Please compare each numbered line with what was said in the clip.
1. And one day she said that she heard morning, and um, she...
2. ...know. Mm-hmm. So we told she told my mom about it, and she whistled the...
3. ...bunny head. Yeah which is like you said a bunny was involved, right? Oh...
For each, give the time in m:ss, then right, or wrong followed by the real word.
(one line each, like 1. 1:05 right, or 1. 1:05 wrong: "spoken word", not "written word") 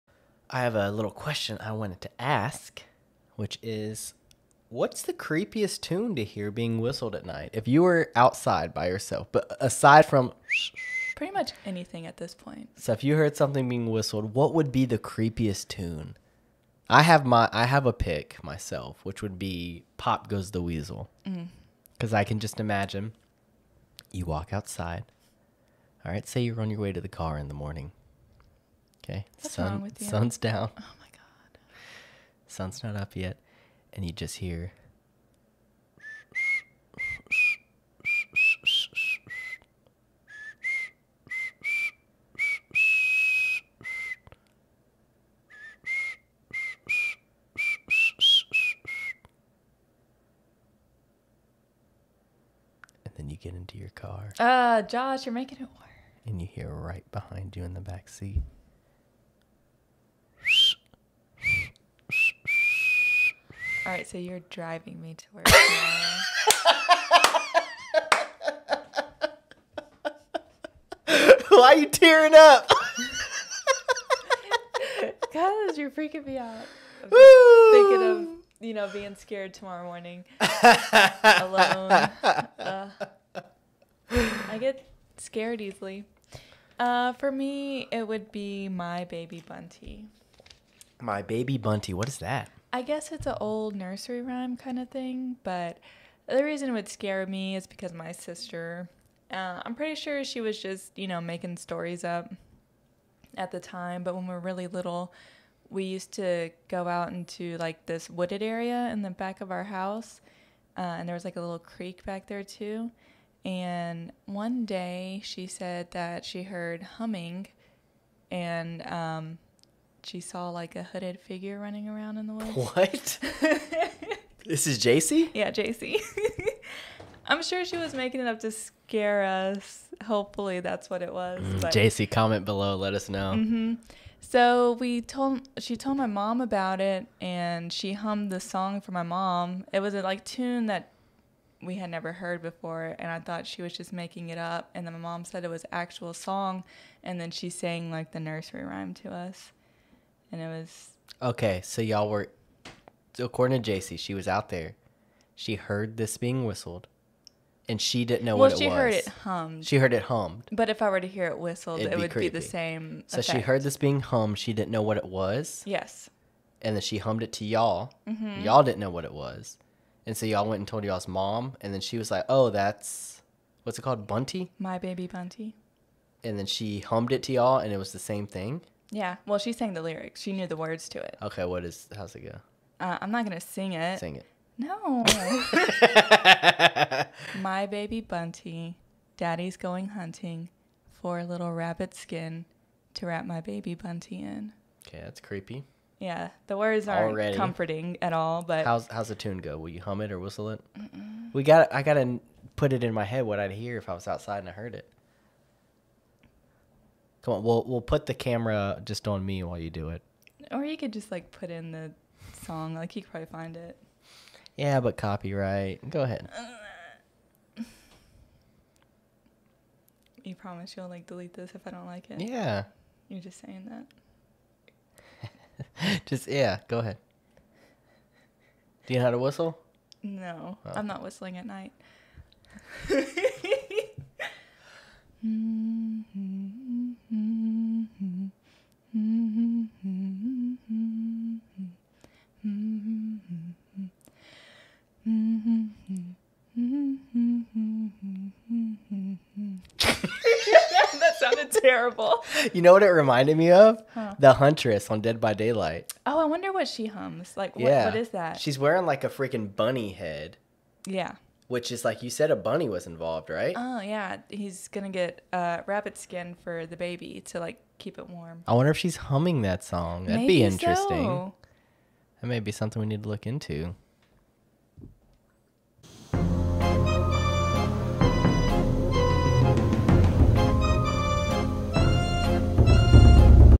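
1. 1:53 wrong: "humming", not "morning"
2. 2:13 wrong: "hummed", not "whistled"
3. 4:19 right.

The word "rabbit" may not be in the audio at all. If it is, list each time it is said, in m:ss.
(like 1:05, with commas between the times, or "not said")
3:11, 4:25.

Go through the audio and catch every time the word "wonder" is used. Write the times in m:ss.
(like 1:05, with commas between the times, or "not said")
4:16, 4:28.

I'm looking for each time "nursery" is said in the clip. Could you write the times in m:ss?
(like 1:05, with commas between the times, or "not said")
1:33, 2:28.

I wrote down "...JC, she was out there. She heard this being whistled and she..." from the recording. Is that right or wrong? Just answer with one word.
right.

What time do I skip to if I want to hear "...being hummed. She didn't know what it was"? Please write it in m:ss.
2:43.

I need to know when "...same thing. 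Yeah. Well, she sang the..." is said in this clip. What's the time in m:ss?
2:57.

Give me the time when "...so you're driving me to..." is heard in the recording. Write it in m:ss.
1:04.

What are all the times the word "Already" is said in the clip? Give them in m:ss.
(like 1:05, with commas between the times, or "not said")
3:17.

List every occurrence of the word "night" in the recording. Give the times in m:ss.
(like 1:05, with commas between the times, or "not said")
0:07, 3:51.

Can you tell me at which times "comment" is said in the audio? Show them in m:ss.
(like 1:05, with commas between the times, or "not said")
2:12.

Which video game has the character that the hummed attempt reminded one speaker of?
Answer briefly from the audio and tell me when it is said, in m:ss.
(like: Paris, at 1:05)
Dead by Daylight, at 4:15.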